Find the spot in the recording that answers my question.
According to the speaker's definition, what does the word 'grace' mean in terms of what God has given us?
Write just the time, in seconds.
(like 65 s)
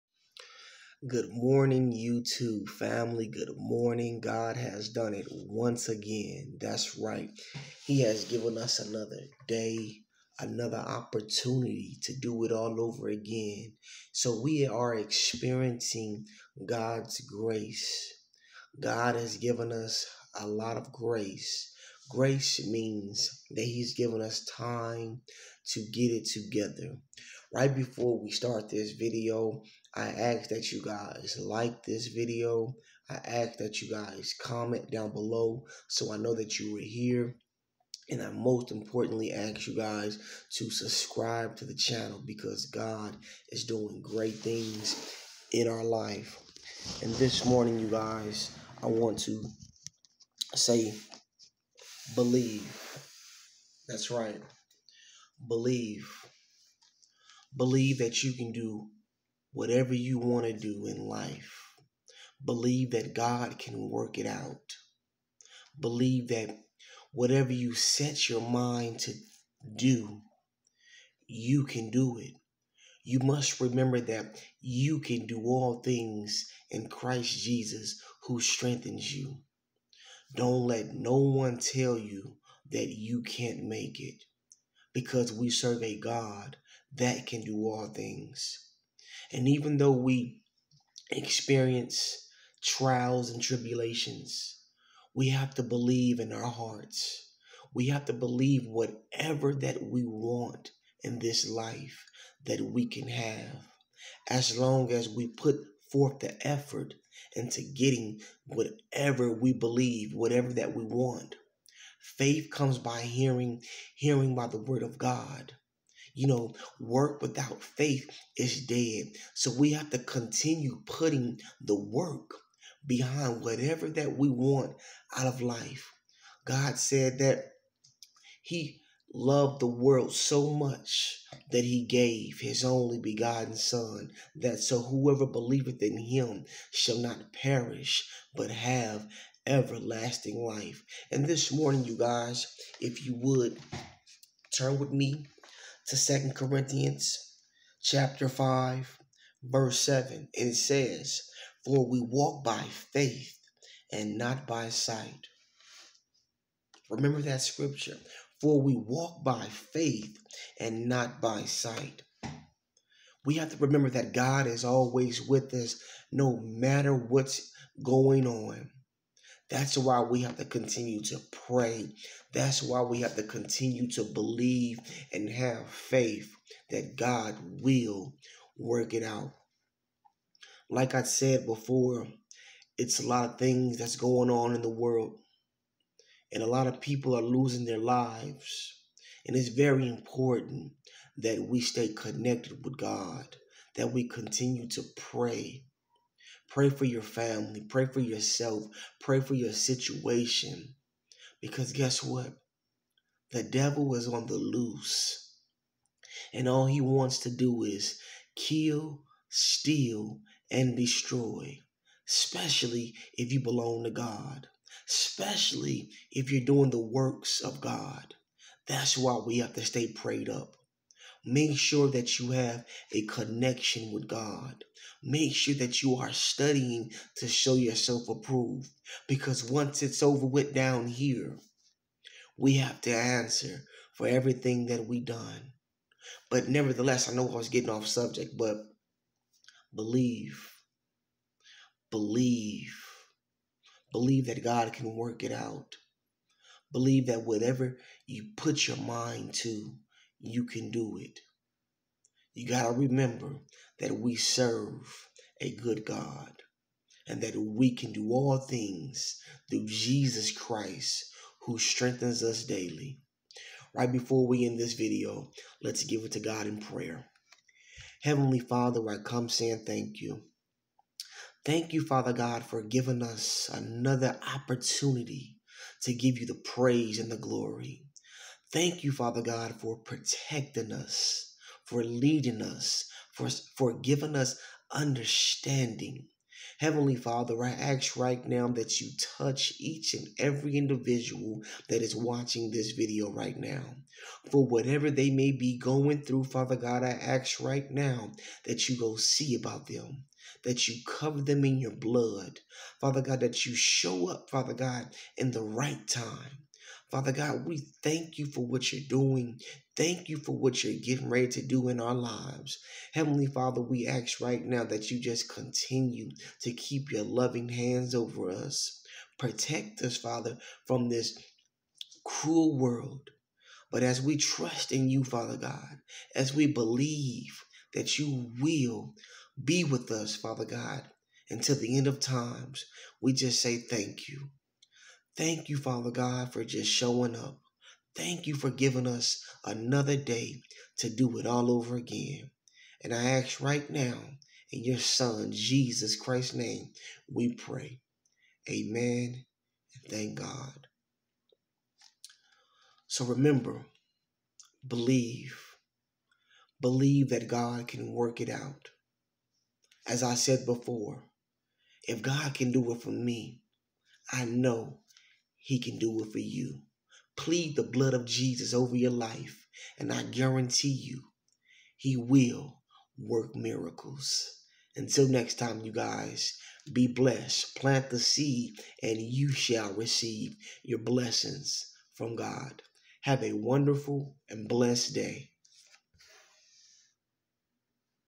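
24 s.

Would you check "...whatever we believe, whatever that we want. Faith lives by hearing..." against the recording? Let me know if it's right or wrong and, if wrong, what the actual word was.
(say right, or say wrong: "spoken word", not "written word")
wrong: "comes", not "lives".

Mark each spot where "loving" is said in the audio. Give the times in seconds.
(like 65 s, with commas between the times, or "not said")
317 s.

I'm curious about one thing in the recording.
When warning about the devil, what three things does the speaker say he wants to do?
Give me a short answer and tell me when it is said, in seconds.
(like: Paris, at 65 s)
Kill, steal, and destroy, at 208 s.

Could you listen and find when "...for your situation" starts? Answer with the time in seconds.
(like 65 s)
199 s.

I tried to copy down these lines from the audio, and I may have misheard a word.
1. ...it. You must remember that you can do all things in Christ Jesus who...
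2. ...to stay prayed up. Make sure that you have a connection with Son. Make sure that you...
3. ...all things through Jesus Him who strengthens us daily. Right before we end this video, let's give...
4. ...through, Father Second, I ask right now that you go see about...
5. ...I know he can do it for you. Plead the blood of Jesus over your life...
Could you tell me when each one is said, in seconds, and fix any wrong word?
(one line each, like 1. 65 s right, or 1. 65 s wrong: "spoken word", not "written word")
1. 72 s right
2. 219 s wrong: "God", not "Son"
3. 258 s wrong: "Christ", not "Him"
4. 296 s wrong: "God", not "Second"
5. 364 s right.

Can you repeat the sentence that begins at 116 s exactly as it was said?
You know, work without faith is dead.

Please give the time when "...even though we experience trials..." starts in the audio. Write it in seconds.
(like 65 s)
89 s.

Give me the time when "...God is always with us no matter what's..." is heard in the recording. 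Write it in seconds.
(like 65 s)
164 s.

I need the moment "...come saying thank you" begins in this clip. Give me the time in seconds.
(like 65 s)
268 s.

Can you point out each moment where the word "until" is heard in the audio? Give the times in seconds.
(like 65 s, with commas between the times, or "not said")
331 s, 374 s.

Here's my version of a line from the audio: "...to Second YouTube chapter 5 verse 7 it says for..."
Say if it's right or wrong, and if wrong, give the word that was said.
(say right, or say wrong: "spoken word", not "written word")
wrong: "Corinthians", not "YouTube".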